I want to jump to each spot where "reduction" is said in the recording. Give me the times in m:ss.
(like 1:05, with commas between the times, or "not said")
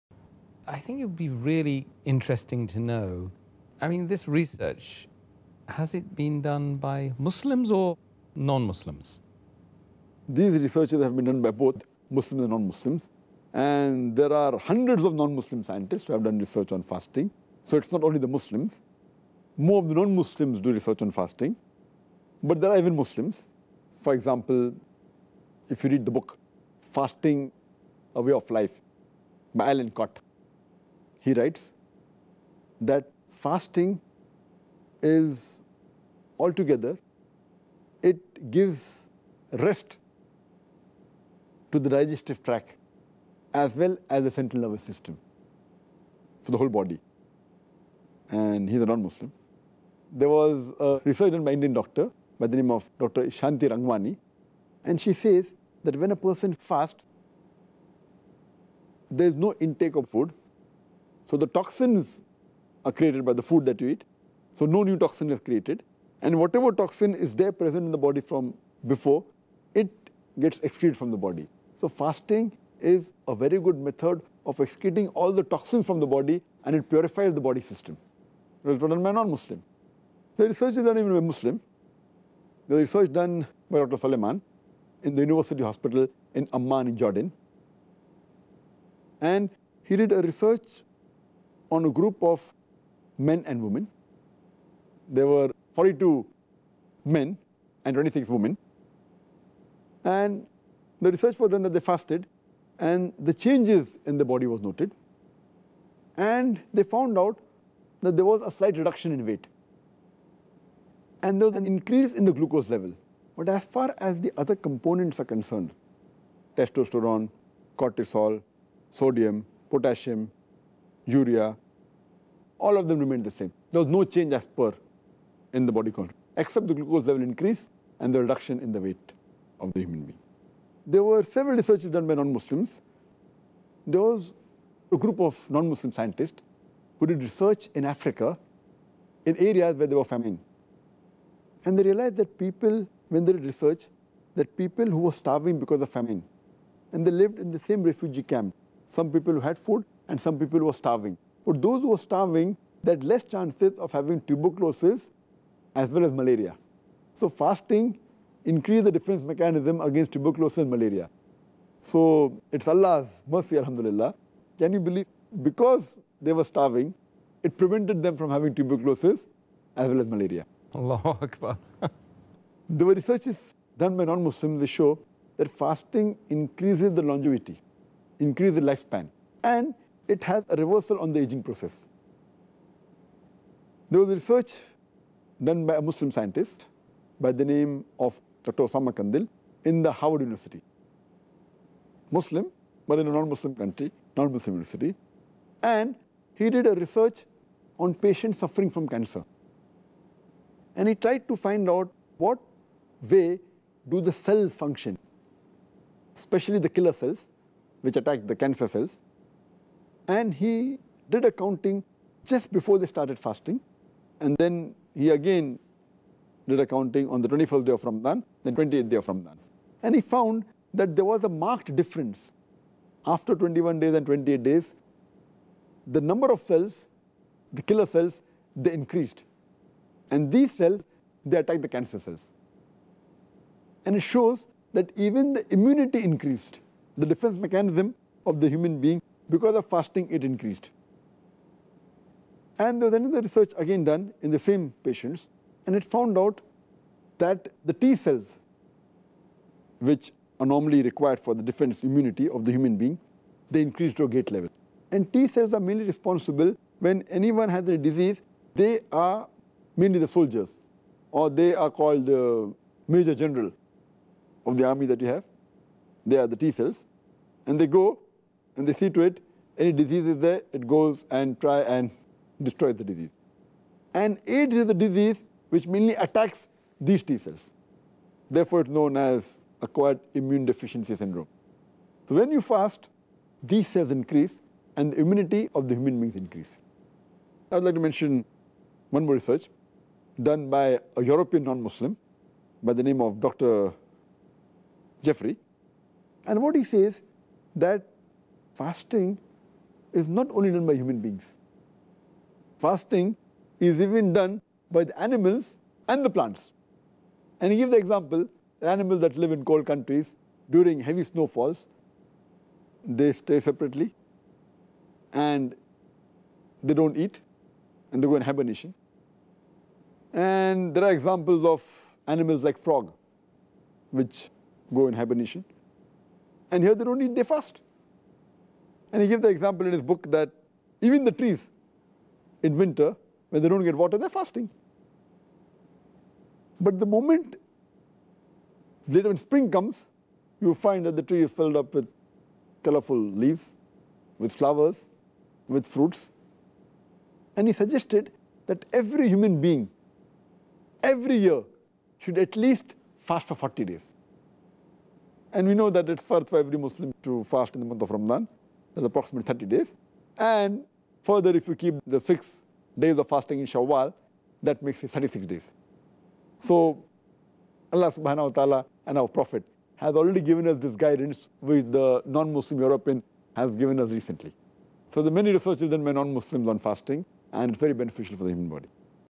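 1:48, 2:08.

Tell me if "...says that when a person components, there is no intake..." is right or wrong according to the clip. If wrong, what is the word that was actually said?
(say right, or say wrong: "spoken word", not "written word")
wrong: "fasts", not "components".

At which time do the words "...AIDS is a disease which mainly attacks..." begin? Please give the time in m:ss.
4:34.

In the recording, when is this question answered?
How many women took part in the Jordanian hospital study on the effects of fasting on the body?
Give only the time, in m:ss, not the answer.
1:37.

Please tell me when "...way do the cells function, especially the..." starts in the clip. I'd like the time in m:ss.
3:23.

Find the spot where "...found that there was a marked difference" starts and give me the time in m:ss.
3:40.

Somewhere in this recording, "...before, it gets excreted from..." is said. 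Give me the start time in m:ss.
1:08.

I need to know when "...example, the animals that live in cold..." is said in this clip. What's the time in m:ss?
5:07.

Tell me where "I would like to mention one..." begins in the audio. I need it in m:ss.
4:47.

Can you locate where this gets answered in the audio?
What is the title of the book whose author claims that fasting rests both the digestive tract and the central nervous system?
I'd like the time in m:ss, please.
0:26.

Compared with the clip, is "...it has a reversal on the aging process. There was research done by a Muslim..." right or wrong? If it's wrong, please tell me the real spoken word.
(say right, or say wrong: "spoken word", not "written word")
right.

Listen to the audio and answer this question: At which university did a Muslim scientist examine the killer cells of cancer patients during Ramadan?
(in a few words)
Howard University.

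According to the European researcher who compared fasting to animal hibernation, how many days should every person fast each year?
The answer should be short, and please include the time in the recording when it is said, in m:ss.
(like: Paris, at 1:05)
40, at 5:53.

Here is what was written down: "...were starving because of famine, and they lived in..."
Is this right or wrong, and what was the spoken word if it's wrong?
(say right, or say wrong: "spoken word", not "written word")
right.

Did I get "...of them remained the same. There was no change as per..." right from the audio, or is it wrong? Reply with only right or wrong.
right.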